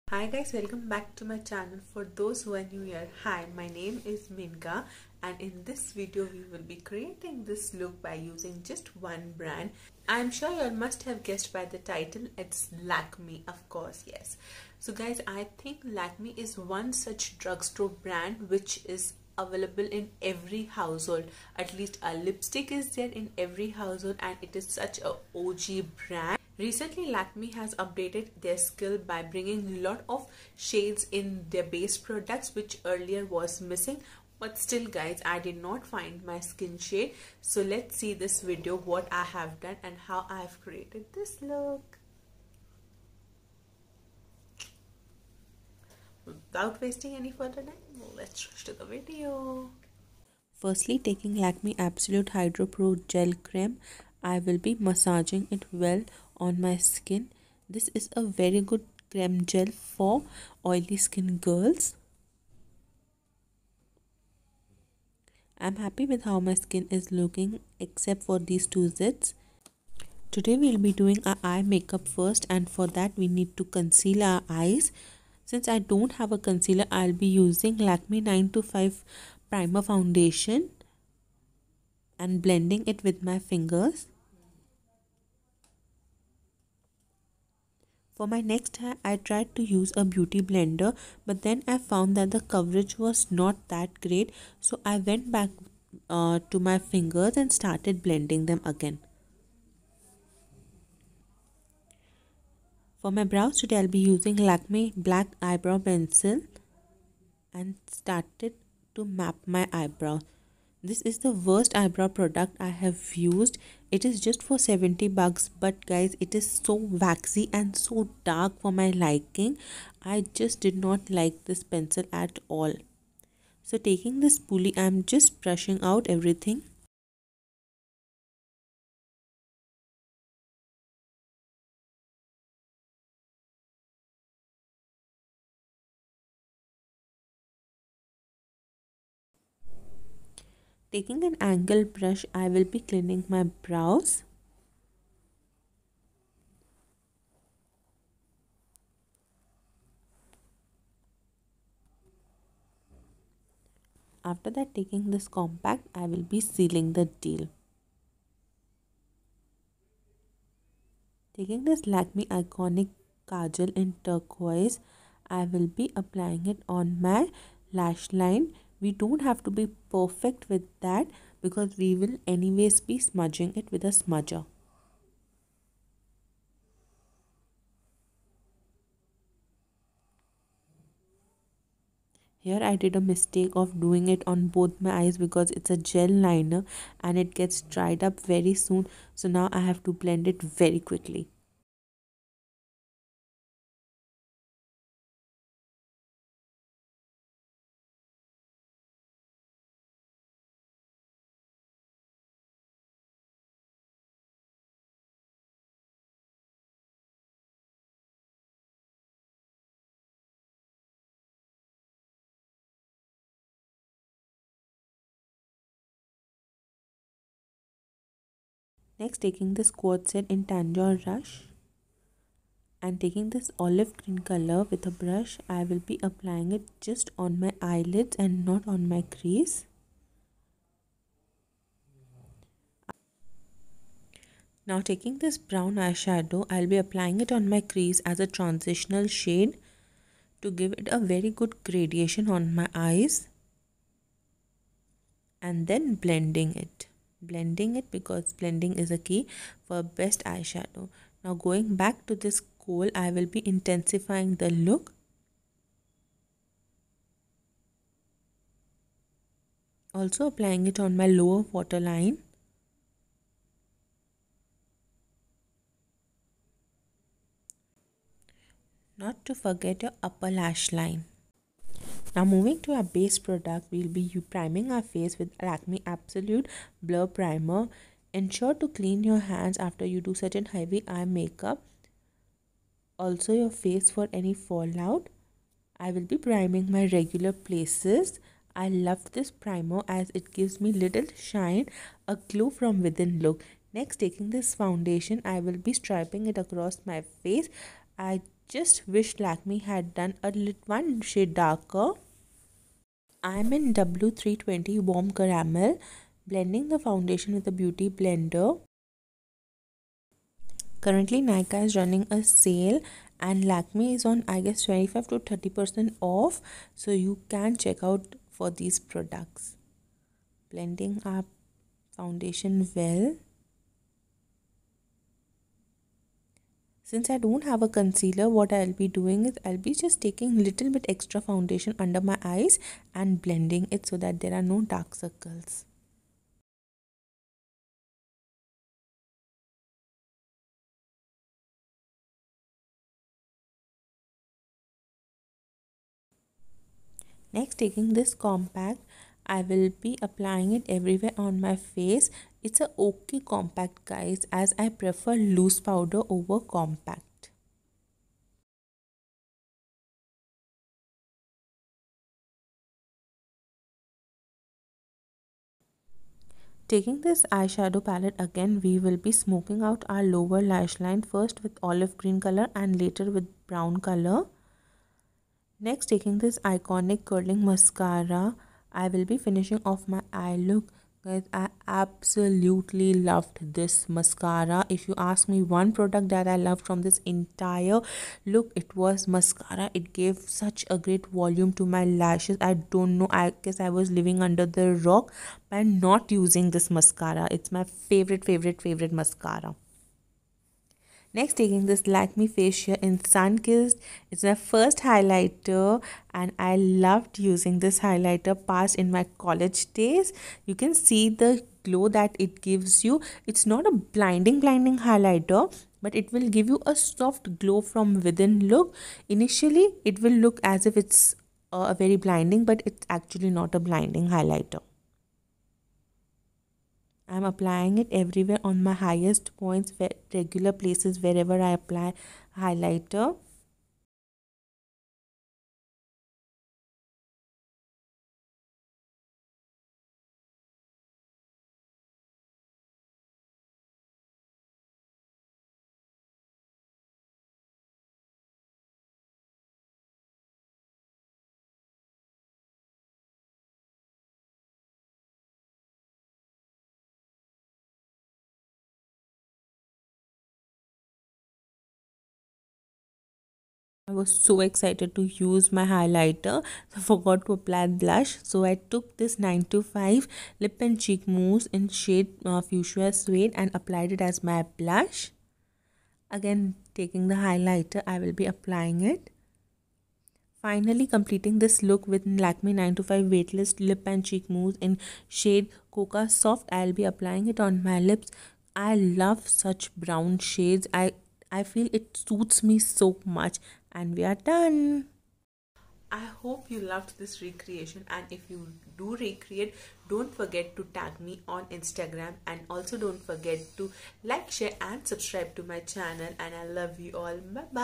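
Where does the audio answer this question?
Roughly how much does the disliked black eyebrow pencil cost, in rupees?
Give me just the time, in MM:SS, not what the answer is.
01:54.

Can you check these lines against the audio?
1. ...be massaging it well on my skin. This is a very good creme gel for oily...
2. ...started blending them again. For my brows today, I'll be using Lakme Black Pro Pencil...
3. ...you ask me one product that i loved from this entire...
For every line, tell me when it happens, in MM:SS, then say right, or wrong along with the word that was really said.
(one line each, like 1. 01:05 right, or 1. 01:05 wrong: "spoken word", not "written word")
1. 00:54 right
2. 01:37 wrong: "Eyebrow", not "Pro"
3. 06:24 right.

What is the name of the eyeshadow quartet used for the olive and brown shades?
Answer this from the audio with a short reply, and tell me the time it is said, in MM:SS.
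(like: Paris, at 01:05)
Tanjore Rush, at 03:40.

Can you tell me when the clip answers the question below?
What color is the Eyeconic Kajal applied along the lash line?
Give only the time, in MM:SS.
02:44.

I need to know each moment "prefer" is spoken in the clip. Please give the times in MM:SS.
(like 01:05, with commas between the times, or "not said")
05:54.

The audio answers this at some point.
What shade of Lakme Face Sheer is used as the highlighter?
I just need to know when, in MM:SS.
06:42.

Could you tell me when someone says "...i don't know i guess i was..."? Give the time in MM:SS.
06:32.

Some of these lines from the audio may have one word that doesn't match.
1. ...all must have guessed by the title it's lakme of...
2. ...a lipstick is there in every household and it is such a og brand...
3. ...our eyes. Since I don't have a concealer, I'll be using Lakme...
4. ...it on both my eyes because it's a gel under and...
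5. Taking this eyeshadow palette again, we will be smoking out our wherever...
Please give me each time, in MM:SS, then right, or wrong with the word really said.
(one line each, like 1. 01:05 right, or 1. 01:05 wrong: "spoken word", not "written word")
1. 00:10 right
2. 00:22 right
3. 01:14 right
4. 03:04 wrong: "liner", not "under"
5. 06:06 wrong: "lower", not "wherever".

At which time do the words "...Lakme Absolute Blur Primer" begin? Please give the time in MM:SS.
04:35.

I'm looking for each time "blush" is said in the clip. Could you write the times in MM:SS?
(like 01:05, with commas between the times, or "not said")
07:47, 07:54.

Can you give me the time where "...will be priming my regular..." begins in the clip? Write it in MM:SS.
04:45.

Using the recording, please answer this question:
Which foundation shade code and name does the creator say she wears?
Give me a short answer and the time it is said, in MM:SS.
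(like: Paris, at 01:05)
W320 Warm Caramel, at 05:03.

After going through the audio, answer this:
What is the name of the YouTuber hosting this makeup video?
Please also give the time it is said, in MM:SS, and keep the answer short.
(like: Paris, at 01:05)
Menka, at 00:04.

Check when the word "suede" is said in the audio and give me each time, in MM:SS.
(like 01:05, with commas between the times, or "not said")
07:52.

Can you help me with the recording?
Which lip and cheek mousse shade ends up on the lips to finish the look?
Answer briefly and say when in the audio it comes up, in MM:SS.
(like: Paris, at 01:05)
Cocoa Soft, at 08:05.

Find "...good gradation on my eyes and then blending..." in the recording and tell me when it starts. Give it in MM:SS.
04:01.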